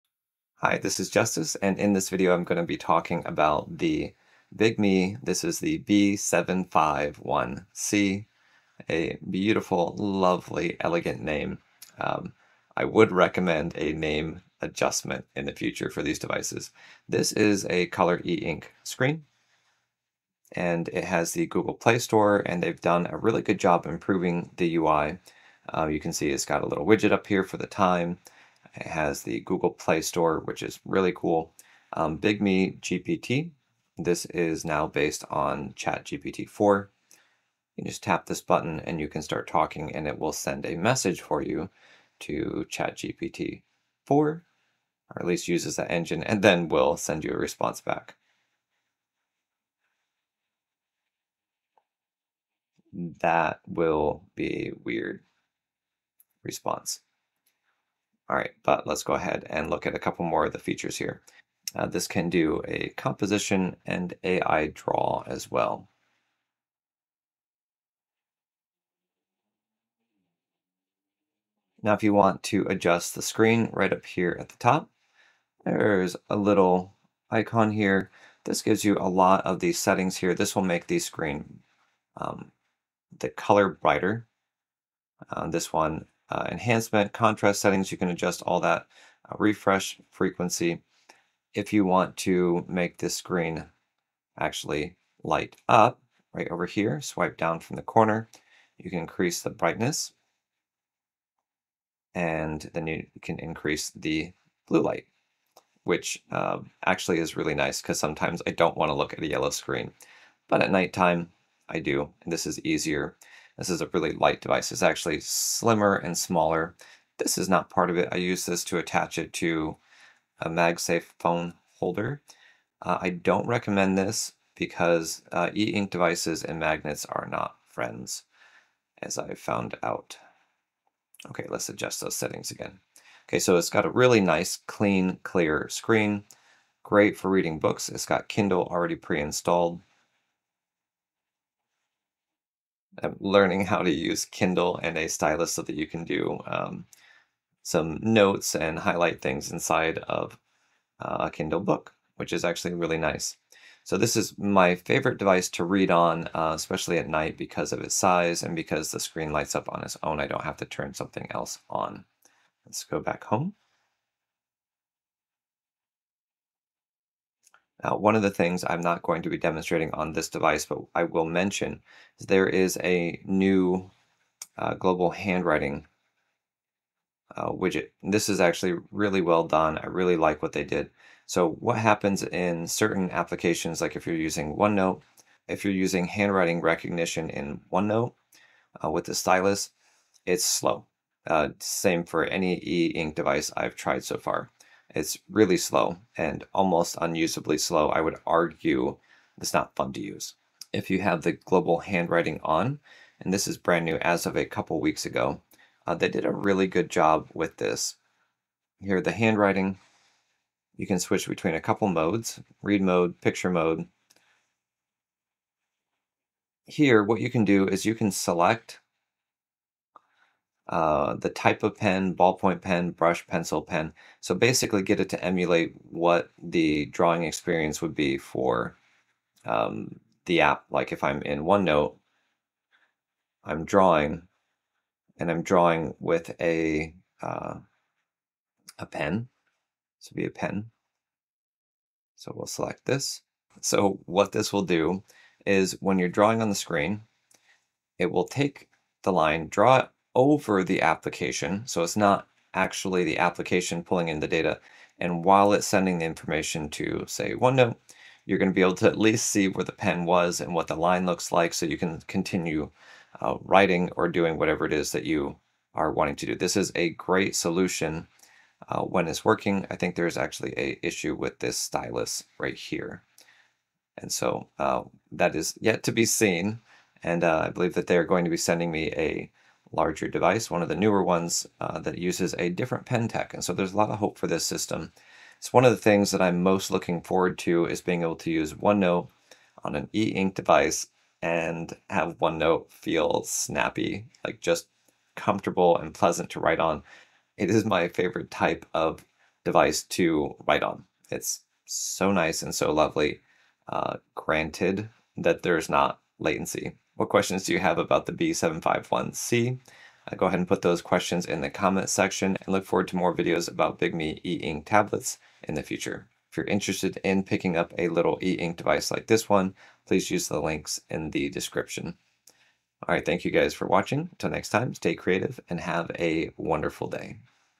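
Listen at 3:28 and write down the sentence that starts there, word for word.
Here, the handwriting, you can switch between a couple modes, read mode, picture mode.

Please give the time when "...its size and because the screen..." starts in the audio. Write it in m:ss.
2:37.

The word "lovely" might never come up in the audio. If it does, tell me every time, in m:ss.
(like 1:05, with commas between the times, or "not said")
0:09, 5:02.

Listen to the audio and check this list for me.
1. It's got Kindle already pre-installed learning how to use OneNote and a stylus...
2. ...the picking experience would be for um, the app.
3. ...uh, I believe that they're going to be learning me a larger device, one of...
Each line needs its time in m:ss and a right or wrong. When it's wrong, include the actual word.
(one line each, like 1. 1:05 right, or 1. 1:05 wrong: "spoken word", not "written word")
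1. 2:17 wrong: "Kindle", not "OneNote"
2. 3:46 wrong: "drawing", not "picking"
3. 4:37 wrong: "sending", not "learning".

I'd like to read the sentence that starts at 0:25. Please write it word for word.
Uh, you can see it's got a little widget up here for the time.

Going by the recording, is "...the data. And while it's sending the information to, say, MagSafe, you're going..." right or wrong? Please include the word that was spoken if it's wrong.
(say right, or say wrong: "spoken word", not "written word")
wrong: "OneNote", not "MagSafe".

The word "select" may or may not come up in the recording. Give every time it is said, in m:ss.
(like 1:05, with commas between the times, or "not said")
3:38, 4:02.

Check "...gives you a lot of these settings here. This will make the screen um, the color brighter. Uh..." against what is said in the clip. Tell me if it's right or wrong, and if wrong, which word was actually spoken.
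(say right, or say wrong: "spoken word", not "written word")
right.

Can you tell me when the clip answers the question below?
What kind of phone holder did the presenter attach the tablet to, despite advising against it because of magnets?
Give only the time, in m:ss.
2:00.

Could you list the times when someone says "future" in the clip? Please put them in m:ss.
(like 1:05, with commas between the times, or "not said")
0:15, 5:15.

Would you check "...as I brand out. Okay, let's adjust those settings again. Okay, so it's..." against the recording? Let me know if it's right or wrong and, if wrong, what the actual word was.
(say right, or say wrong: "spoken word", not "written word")
wrong: "found", not "brand".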